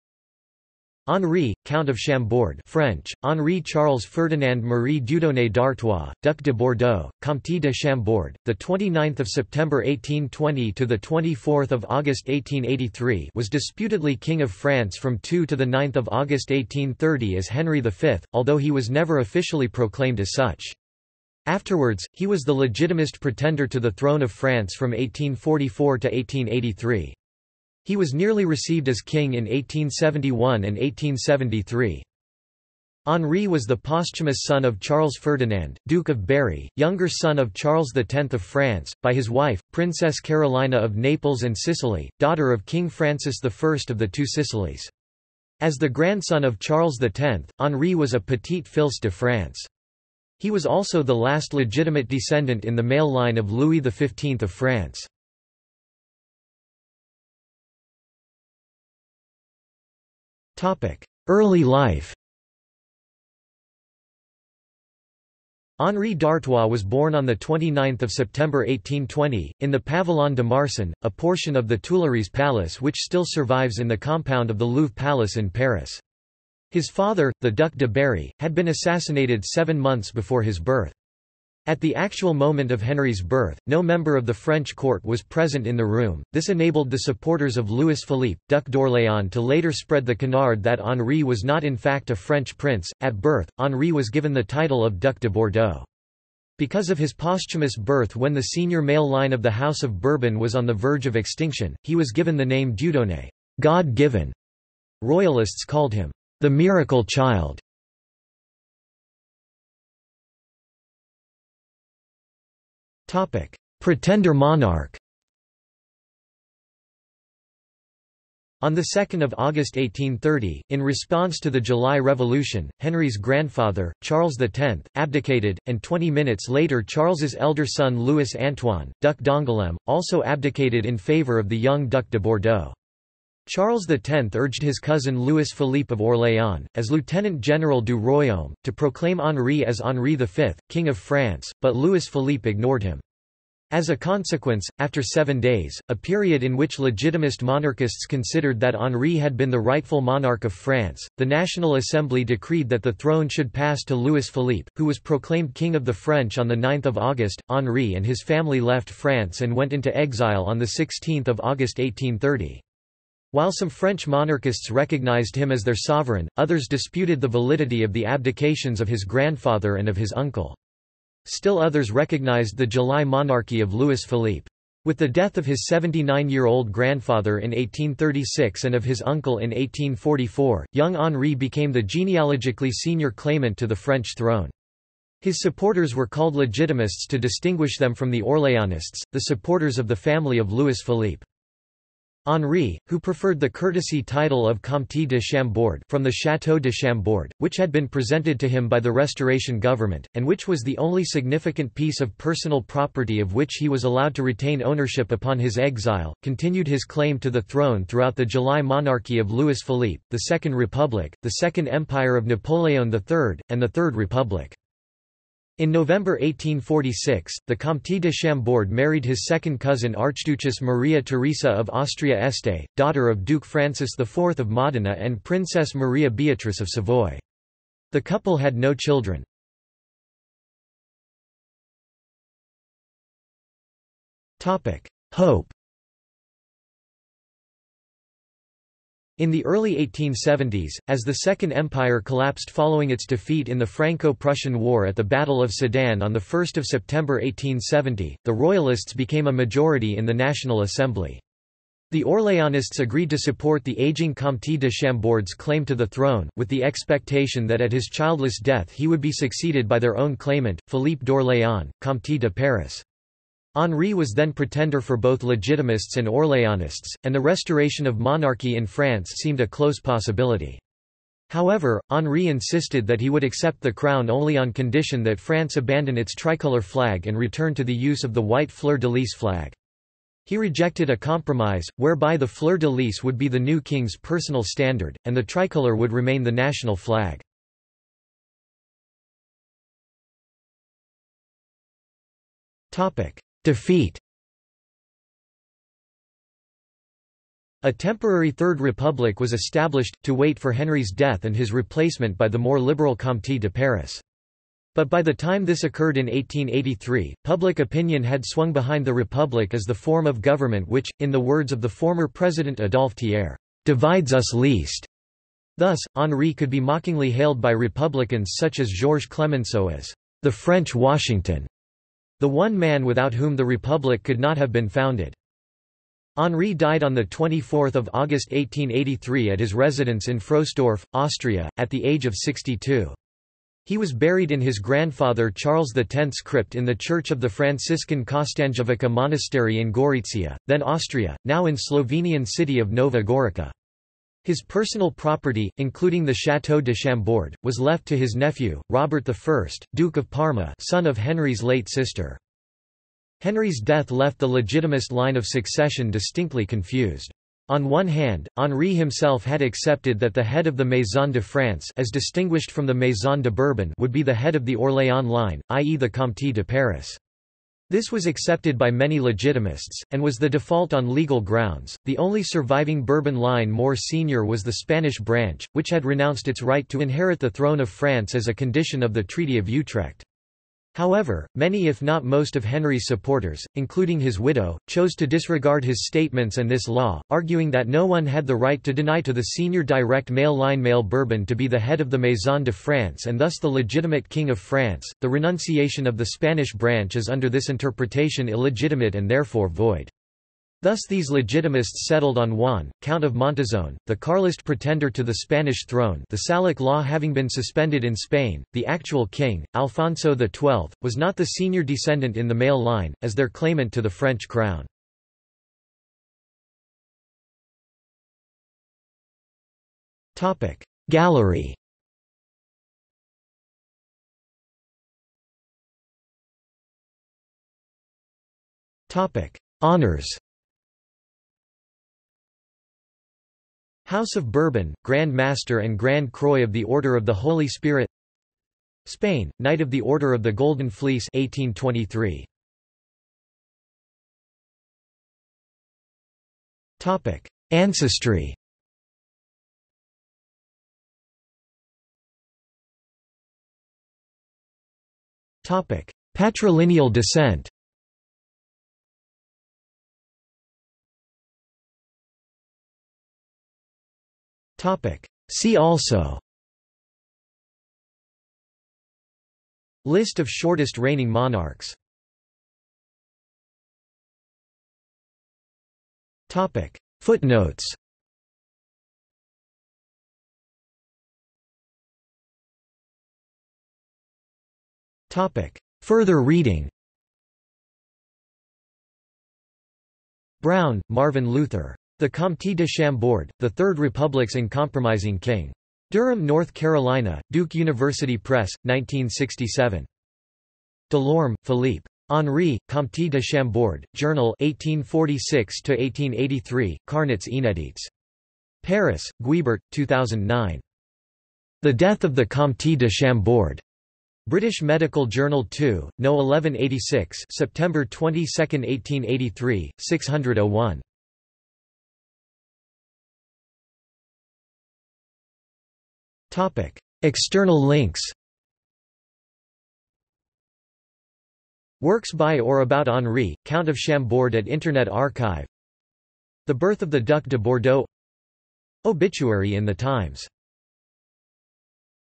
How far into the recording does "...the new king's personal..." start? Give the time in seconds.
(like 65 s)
283 s.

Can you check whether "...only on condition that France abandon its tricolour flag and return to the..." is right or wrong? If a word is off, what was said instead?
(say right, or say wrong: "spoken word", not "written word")
right.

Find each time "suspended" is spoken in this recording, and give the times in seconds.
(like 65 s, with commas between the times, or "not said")
407 s.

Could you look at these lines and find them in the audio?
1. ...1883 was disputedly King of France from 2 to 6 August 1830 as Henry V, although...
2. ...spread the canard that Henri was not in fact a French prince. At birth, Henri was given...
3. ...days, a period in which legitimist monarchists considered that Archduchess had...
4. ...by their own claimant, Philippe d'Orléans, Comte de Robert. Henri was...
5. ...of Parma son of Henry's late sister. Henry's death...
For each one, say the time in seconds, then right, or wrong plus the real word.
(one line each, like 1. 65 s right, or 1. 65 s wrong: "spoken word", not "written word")
1. 12 s wrong: "9", not "6"
2. 89 s right
3. 145 s wrong: "Henri", not "Archduchess"
4. 259 s wrong: "Paris", not "Robert"
5. 349 s right.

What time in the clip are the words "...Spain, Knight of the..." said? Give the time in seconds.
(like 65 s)
438 s.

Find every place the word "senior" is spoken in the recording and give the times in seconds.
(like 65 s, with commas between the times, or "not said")
98 s, 182 s, 373 s, 389 s, 411 s.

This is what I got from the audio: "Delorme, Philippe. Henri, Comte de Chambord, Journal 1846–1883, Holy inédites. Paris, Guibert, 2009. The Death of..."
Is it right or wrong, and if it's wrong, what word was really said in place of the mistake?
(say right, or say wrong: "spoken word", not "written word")
wrong: "Carnets", not "Holy".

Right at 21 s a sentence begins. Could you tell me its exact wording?
Afterwards, he was the legitimist pretender to the throne of France from 1844 to 1883.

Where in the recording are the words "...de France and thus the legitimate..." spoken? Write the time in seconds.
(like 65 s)
392 s.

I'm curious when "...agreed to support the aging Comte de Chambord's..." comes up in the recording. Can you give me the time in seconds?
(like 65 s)
252 s.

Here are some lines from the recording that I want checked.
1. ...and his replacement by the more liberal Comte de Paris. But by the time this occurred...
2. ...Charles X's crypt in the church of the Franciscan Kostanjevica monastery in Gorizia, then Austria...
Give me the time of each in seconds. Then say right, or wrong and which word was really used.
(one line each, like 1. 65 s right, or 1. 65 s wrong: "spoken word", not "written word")
1. 301 s right
2. 335 s right.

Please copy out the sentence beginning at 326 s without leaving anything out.
Henri died on 24 August 1883 at his residence in Frohsdorf, Austria, at the age of 62.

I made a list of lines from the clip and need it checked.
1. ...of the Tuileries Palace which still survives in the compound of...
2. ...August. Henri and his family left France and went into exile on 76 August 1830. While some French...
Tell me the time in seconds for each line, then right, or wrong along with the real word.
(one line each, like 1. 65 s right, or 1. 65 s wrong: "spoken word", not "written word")
1. 71 s right
2. 156 s wrong: "16", not "76".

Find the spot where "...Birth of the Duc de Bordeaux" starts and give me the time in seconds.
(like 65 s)
536 s.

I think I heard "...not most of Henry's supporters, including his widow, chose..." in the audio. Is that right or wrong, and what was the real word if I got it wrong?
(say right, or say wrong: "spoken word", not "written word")
right.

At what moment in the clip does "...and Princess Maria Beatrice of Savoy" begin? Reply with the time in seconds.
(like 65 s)
224 s.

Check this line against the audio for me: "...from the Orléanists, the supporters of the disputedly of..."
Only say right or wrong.
wrong.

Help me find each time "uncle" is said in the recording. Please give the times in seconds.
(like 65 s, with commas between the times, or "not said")
170 s, 179 s.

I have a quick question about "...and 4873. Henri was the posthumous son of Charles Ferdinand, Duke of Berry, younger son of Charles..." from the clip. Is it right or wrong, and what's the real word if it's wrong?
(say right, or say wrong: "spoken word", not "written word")
wrong: "1873", not "4873".